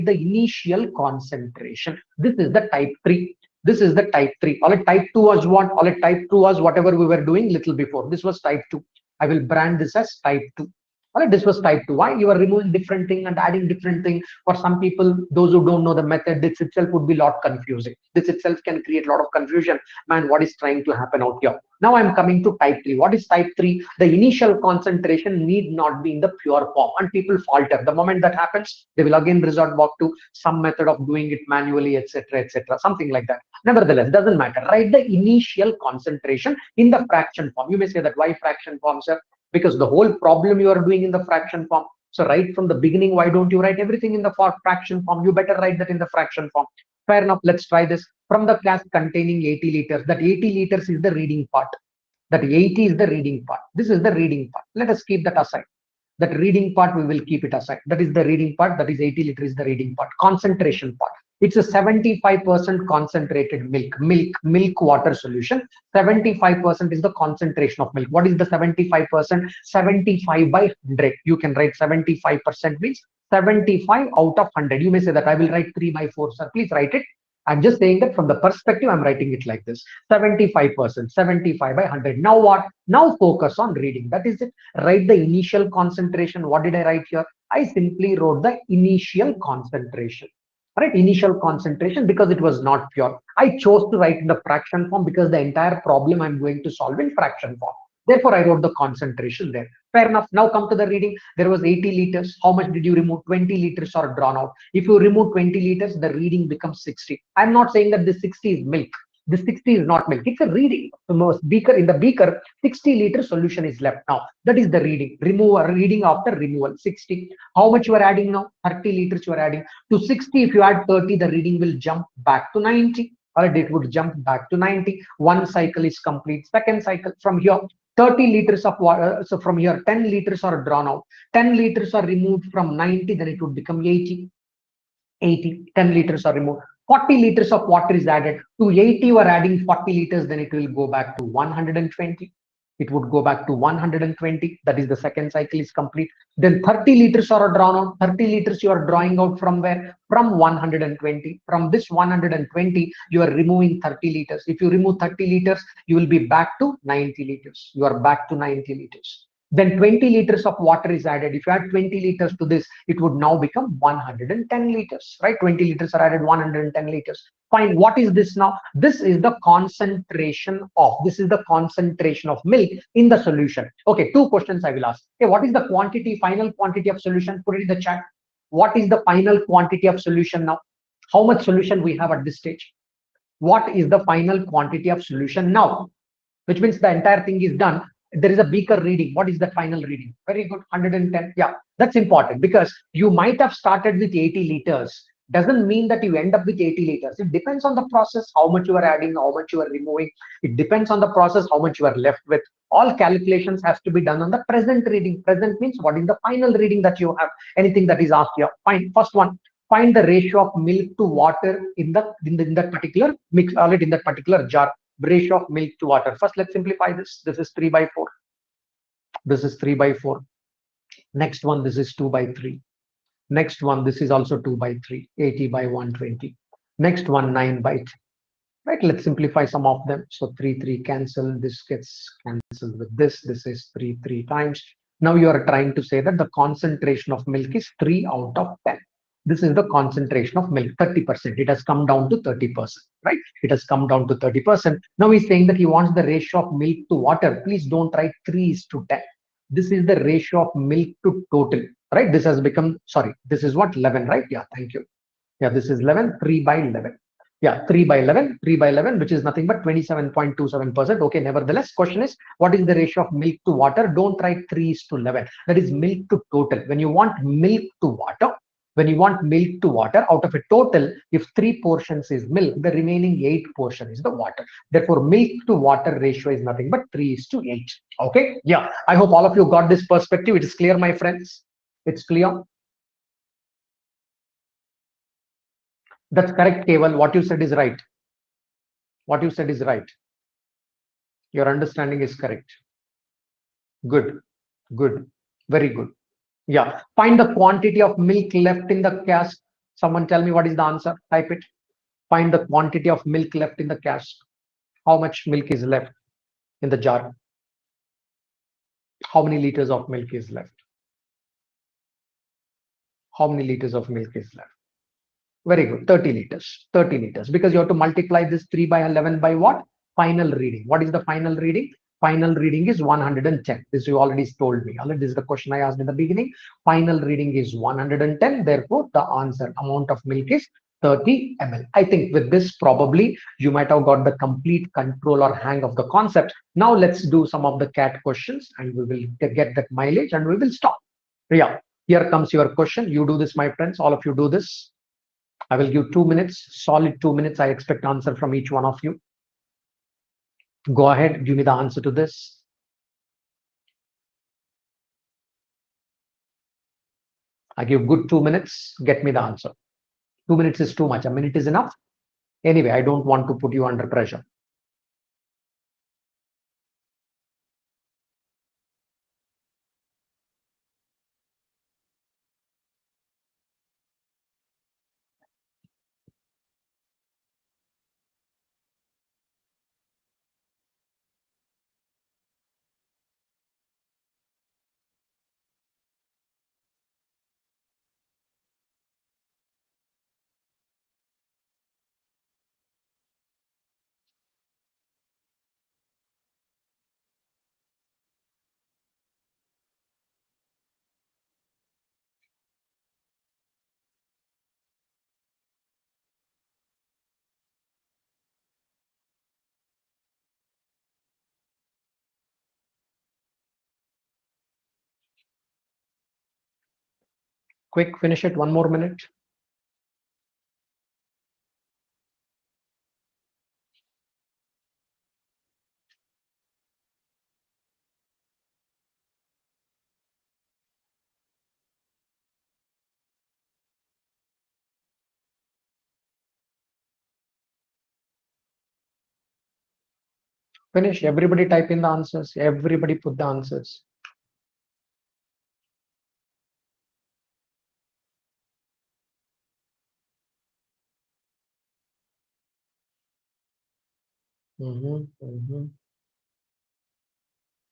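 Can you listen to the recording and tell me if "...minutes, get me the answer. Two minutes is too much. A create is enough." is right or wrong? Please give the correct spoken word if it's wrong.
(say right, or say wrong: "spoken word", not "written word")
wrong: "minute", not "create".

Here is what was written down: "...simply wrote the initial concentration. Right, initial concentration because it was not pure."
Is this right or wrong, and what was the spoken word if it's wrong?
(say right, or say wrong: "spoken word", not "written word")
right.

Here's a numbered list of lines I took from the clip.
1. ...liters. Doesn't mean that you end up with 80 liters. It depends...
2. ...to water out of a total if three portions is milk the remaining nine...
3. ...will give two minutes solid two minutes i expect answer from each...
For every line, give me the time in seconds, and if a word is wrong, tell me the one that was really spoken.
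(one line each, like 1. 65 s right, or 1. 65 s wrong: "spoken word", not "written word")
1. 194 s right
2. 269 s wrong: "eight", not "nine"
3. 345 s right.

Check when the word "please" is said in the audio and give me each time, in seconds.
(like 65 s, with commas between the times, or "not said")
76 s, 247 s.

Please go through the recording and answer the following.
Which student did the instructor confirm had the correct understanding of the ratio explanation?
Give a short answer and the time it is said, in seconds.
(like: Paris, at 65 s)
Keval, at 286 s.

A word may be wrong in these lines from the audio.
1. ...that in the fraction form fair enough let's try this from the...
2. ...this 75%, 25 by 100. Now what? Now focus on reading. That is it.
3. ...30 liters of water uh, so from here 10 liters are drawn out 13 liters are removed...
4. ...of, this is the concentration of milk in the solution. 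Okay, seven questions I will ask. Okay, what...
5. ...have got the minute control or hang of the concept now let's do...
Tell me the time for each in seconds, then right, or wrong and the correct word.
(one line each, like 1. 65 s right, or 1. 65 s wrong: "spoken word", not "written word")
1. 45 s right
2. 79 s wrong: "75", not "25"
3. 127 s wrong: "10", not "13"
4. 170 s wrong: "two", not "seven"
5. 333 s wrong: "complete", not "minute".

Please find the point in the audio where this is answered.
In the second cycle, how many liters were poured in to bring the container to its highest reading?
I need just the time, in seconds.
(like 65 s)
136 s.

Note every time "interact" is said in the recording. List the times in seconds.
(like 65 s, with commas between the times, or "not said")
not said.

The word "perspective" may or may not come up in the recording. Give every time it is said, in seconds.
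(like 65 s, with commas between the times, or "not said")
78 s, 279 s.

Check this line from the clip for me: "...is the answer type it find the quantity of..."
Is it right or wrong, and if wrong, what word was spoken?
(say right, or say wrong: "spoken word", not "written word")
right.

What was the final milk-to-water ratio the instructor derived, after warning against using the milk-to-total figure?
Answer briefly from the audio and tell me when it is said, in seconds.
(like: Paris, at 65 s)
3:8, at 276 s.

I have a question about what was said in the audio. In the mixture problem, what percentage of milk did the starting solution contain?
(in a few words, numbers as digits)
75%.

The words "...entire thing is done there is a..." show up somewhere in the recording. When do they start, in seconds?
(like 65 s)
186 s.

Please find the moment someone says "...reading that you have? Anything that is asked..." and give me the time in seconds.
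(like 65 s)
206 s.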